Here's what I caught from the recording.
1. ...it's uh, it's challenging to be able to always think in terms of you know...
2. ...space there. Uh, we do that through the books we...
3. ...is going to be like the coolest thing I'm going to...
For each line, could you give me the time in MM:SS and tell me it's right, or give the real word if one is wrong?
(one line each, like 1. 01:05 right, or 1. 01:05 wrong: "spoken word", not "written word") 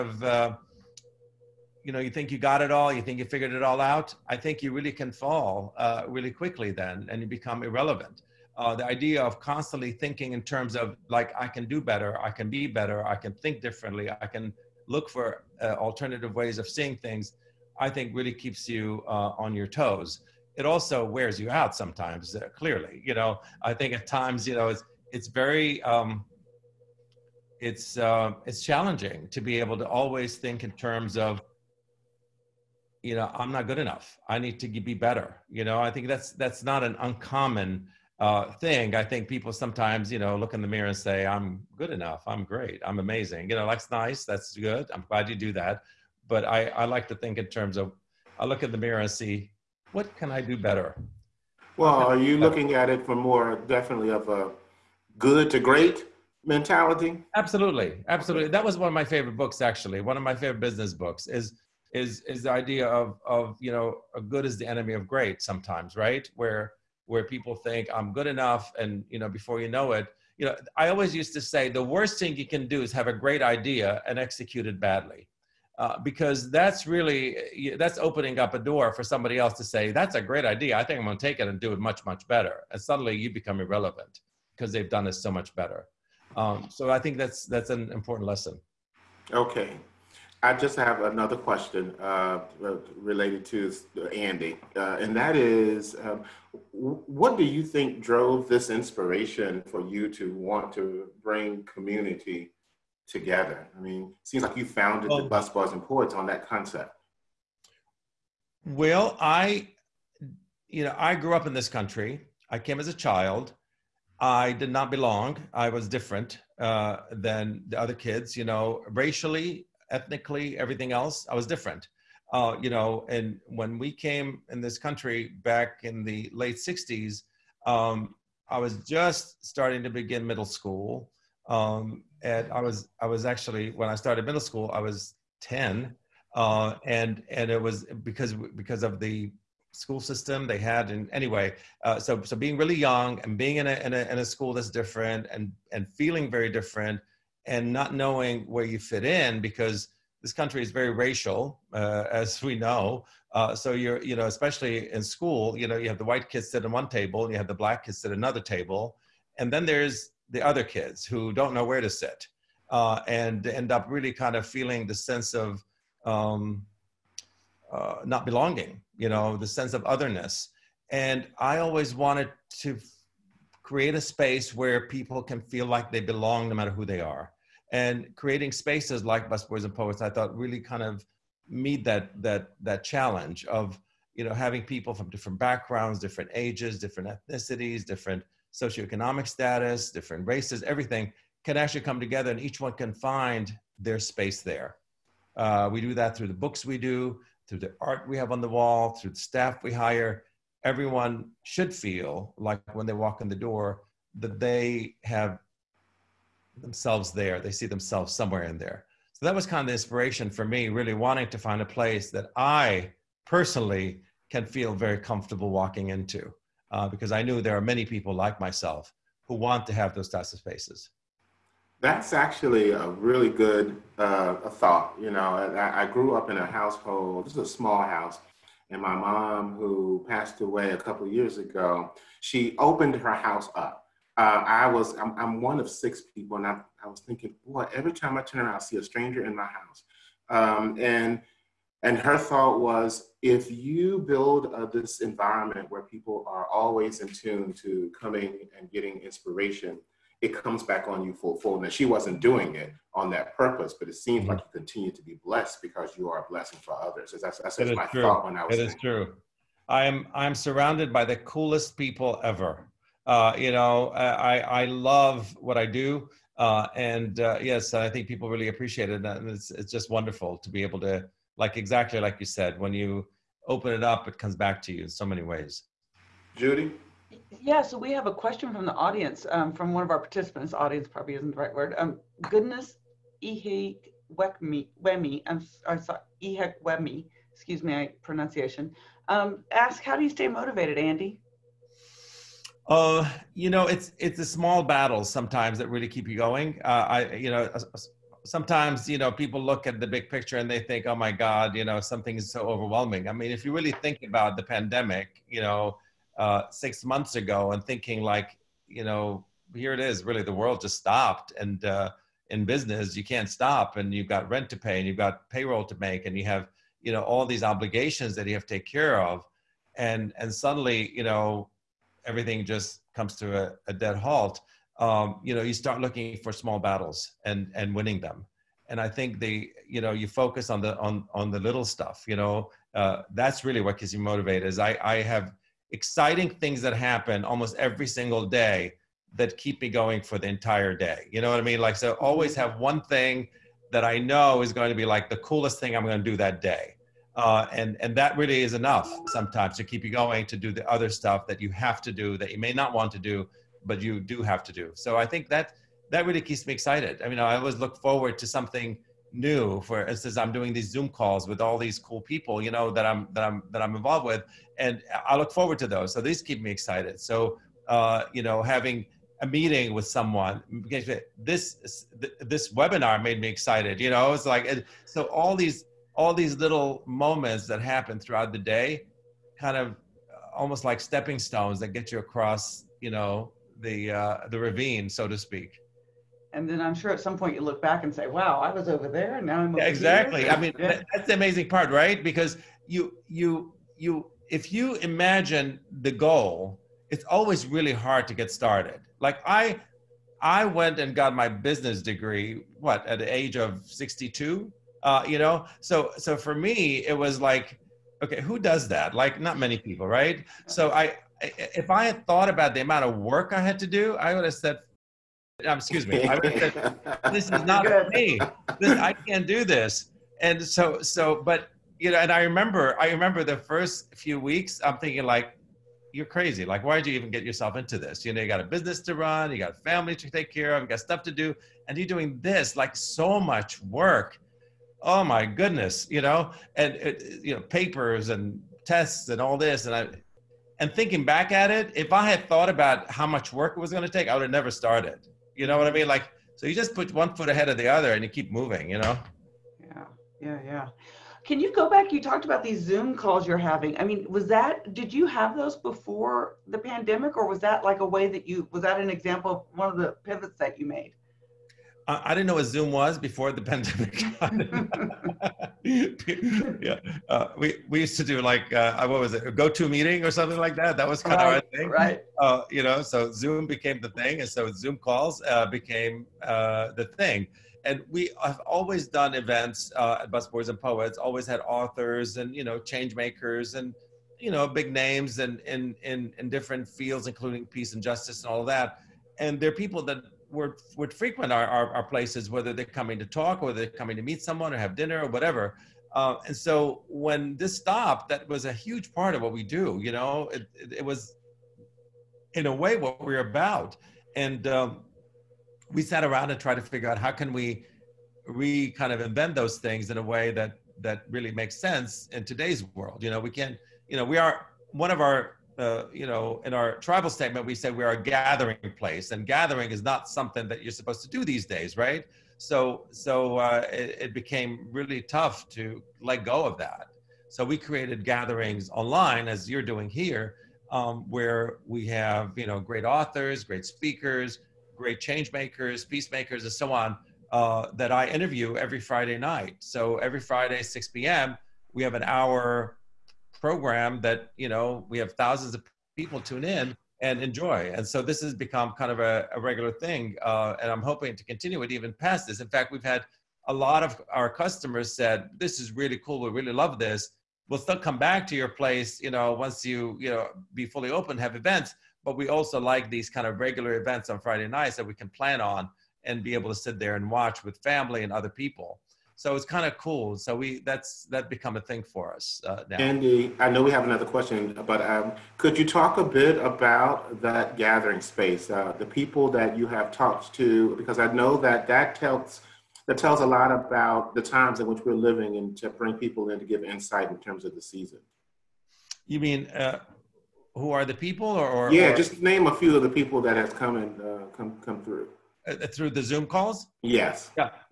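1. 00:27 right
2. 03:13 right
3. 05:44 right.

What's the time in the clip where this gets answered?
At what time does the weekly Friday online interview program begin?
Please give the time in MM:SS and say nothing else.
09:00.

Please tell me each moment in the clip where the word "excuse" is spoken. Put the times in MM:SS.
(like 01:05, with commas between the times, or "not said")
04:47, 06:55.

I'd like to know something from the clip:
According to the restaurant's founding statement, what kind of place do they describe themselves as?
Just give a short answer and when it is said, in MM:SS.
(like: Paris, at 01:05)
A gathering place, at 08:38.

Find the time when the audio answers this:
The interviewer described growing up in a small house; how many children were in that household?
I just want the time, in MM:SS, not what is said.
03:55.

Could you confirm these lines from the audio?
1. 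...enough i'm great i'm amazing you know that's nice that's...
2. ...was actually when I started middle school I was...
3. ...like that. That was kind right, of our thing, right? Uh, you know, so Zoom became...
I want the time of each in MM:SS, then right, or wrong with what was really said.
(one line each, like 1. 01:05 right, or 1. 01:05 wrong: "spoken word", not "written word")
1. 00:41 right
2. 02:13 right
3. 07:50 right.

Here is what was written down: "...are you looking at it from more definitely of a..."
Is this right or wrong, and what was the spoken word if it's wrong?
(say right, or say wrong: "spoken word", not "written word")
right.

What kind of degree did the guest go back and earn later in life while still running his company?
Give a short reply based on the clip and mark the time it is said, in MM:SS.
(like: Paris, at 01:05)
Business degree, at 06:41.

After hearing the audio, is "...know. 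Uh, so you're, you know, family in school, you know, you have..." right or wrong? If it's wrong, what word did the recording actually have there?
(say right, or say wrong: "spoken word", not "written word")
wrong: "especially", not "family".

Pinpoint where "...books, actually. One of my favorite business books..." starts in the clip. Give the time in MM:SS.
00:59.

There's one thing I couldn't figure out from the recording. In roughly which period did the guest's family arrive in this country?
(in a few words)
Late '60s.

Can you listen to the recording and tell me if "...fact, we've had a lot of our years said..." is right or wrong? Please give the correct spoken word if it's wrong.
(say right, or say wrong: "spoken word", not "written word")
wrong: "customers", not "years".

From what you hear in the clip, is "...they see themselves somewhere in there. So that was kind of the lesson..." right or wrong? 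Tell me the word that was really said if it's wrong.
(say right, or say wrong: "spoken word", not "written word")
wrong: "inspiration", not "lesson".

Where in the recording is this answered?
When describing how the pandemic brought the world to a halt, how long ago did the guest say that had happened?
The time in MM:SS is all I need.
05:06.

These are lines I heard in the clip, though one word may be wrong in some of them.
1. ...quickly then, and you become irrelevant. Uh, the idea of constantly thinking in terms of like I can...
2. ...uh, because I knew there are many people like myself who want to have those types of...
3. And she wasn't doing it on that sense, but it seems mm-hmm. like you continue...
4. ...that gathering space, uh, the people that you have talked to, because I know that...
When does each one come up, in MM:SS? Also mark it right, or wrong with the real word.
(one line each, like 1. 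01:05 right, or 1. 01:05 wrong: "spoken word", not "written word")
1. 00:06 right
2. 03:36 right
3. 04:11 wrong: "purpose", not "sense"
4. 09:37 right.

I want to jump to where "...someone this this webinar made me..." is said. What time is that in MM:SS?
06:09.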